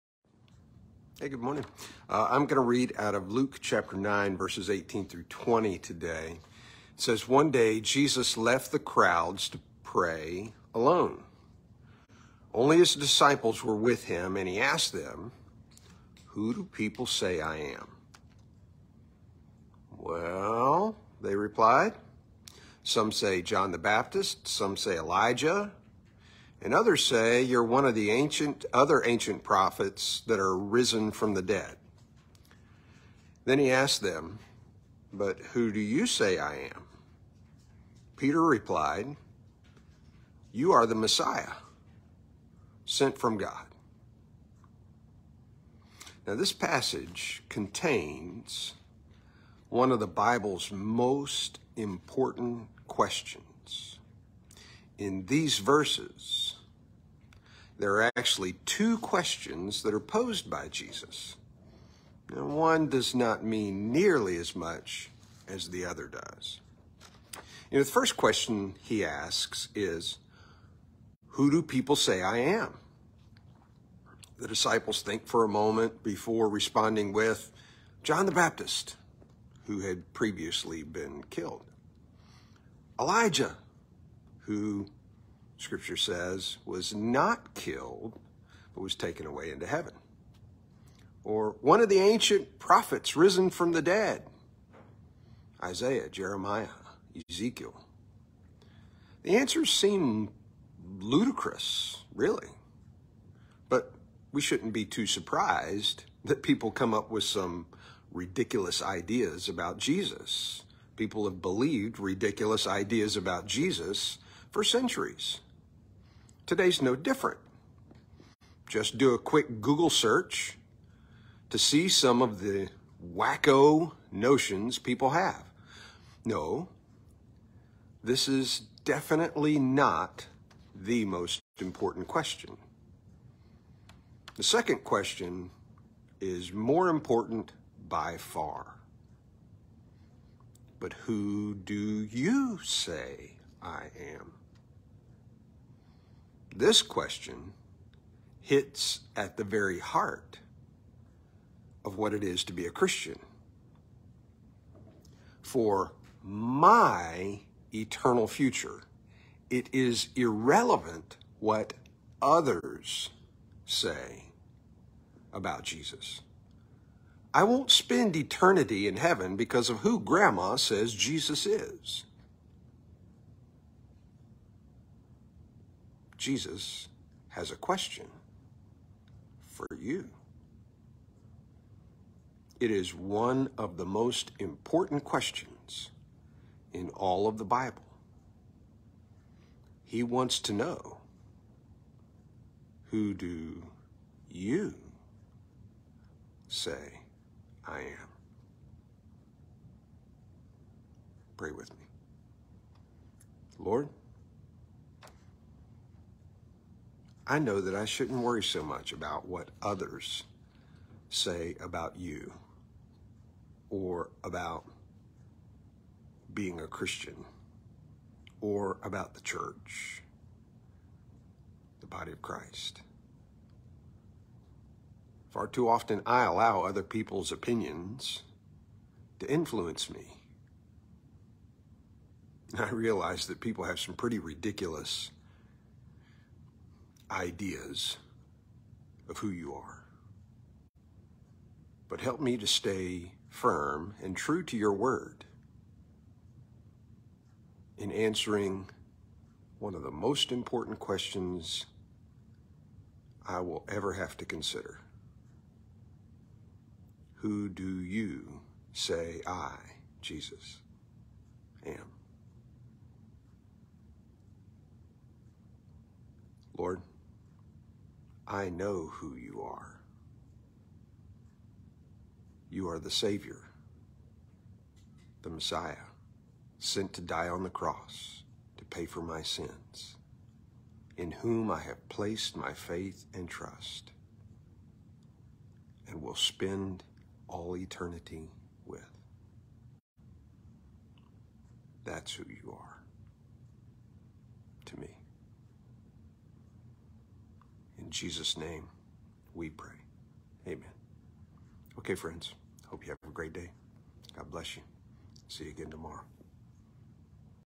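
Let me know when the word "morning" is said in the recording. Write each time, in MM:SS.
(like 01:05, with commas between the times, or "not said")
00:01.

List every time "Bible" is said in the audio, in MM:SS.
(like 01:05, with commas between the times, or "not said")
00:50, 03:07.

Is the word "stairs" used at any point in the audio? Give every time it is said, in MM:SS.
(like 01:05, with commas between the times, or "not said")
not said.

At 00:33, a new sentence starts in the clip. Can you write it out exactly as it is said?
Then he asked them, But who do you say I am?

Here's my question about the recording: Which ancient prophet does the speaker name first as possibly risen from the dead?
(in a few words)
Isaiah.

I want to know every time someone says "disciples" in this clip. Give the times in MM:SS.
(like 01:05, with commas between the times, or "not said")
00:12, 01:14.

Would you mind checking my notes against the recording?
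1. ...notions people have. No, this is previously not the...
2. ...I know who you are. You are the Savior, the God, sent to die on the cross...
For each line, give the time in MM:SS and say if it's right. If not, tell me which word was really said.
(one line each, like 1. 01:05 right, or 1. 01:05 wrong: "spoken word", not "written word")
1. 02:04 wrong: "definitely", not "previously"
2. 04:28 wrong: "Messiah", not "God".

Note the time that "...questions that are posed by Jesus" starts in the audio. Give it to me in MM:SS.
00:58.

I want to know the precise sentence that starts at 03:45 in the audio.
Far too often, I allow other people's opinions to influence me.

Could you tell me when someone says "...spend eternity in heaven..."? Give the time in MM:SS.
02:47.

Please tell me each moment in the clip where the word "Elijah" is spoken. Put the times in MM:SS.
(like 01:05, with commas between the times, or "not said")
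00:24, 01:22.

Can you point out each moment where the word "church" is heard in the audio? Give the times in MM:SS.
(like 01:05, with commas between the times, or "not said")
03:39.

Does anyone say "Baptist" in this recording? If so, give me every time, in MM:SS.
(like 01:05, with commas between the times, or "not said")
00:23, 01:18.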